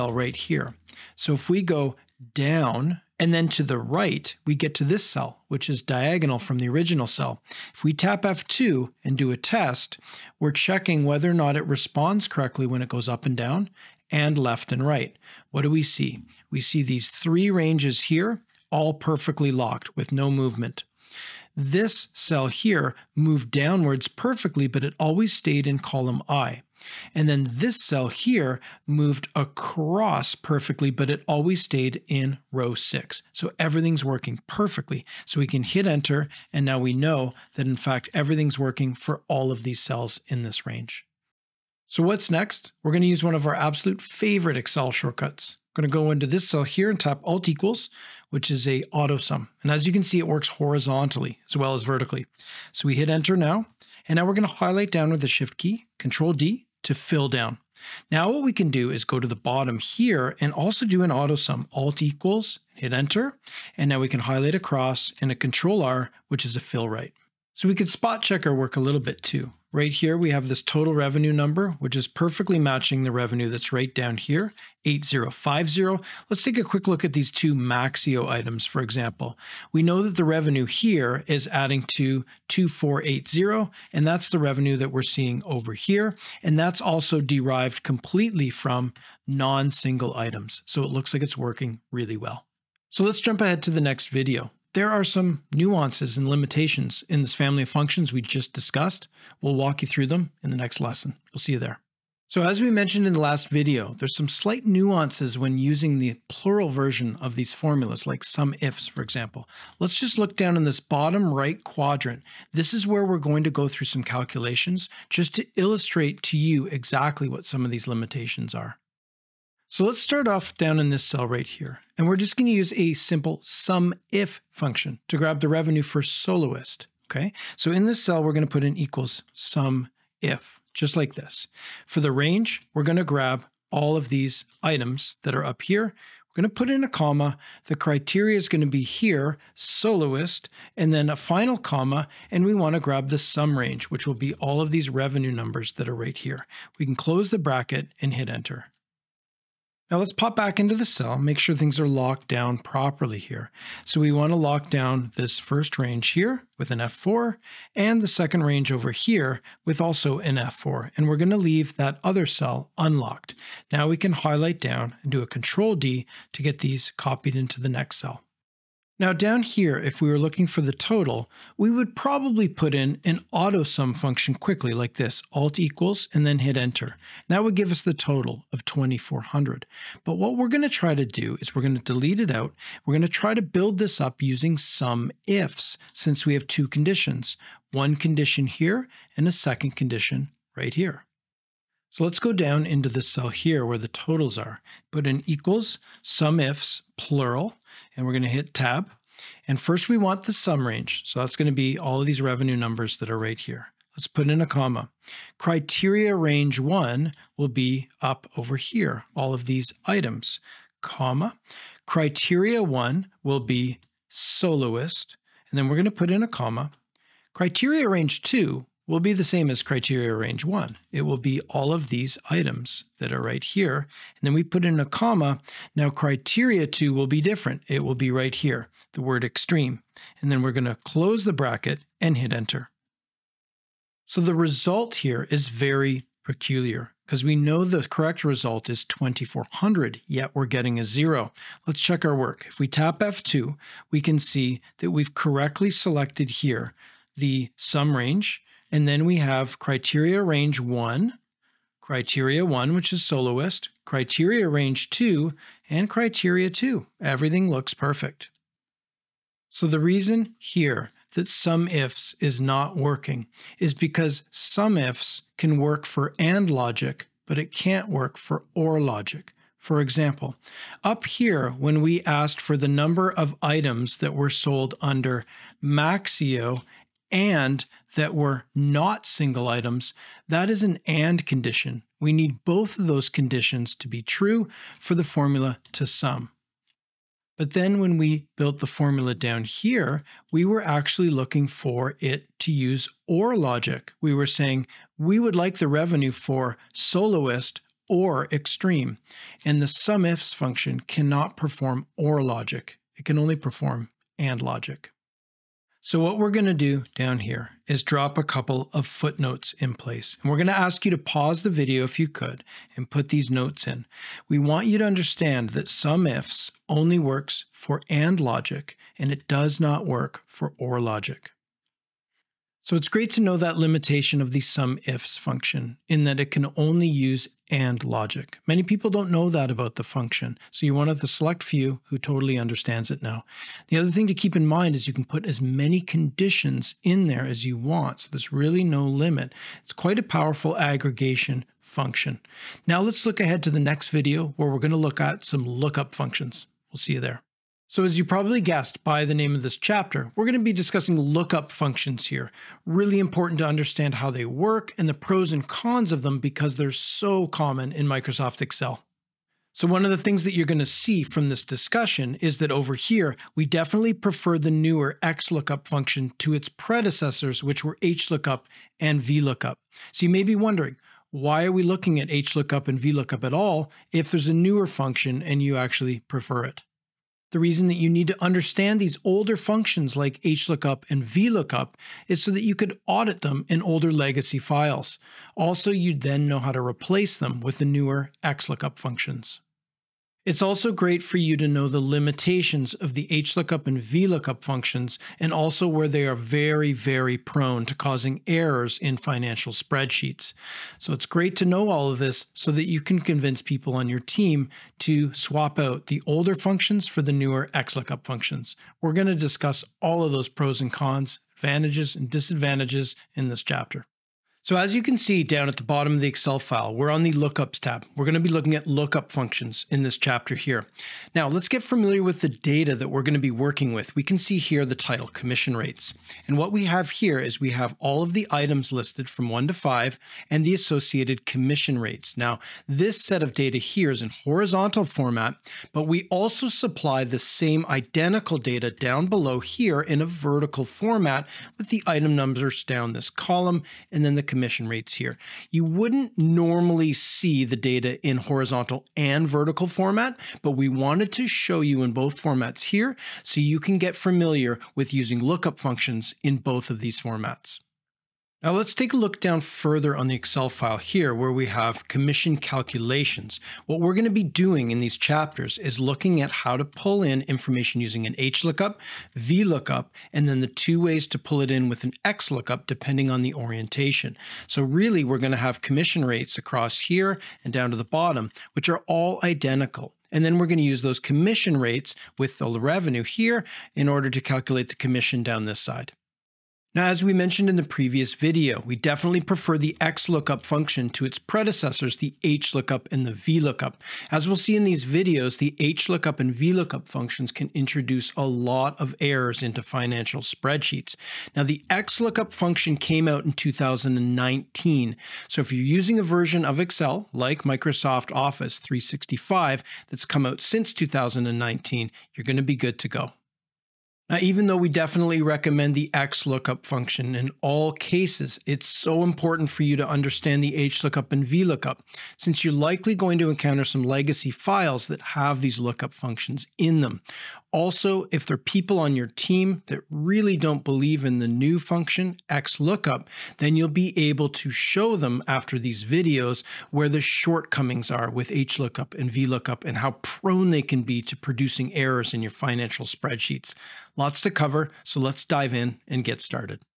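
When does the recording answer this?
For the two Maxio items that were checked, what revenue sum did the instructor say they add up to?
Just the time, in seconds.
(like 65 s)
82 s.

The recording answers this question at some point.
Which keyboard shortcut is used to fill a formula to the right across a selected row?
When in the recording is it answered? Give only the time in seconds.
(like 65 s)
65 s.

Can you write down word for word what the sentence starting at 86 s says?
And that's also derived completely from non-single items.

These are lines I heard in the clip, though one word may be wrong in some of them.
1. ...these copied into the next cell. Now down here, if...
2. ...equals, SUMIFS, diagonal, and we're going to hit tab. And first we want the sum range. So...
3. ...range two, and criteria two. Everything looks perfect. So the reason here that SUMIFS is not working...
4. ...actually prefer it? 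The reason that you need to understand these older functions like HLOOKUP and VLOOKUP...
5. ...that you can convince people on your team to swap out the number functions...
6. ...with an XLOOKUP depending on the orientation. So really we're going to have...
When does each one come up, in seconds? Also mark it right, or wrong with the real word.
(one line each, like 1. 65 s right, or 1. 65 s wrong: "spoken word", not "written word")
1. 166 s right
2. 195 s wrong: "plural", not "diagonal"
3. 254 s right
4. 375 s right
5. 402 s wrong: "older", not "number"
6. 471 s right.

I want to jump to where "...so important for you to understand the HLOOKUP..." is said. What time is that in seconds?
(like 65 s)
518 s.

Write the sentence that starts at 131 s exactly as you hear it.
For the range, we're going to grab all of these items that are up here.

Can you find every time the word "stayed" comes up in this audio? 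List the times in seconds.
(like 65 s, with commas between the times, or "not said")
25 s, 31 s.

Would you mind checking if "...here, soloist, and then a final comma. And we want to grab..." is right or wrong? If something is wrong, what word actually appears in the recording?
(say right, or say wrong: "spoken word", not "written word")
right.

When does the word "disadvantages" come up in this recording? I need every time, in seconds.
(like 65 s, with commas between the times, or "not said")
412 s.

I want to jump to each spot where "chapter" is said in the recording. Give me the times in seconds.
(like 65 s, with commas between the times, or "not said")
349 s, 413 s, 419 s, 464 s.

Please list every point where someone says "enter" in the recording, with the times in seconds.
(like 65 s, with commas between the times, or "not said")
35 s, 53 s, 62 s, 148 s, 176 s, 232 s.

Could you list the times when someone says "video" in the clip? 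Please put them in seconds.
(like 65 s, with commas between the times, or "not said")
94 s, 103 s, 311 s, 343 s, 488 s, 494 s, 535 s.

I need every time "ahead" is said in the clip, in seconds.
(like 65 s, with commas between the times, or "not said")
93 s, 343 s.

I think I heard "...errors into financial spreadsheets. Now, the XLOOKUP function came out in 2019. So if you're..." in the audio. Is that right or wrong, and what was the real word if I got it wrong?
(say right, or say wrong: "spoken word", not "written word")
right.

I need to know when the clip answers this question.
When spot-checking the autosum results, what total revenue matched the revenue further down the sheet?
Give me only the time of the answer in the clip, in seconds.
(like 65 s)
74 s.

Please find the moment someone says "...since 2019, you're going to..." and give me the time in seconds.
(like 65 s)
510 s.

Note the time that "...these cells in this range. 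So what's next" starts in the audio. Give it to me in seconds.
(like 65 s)
39 s.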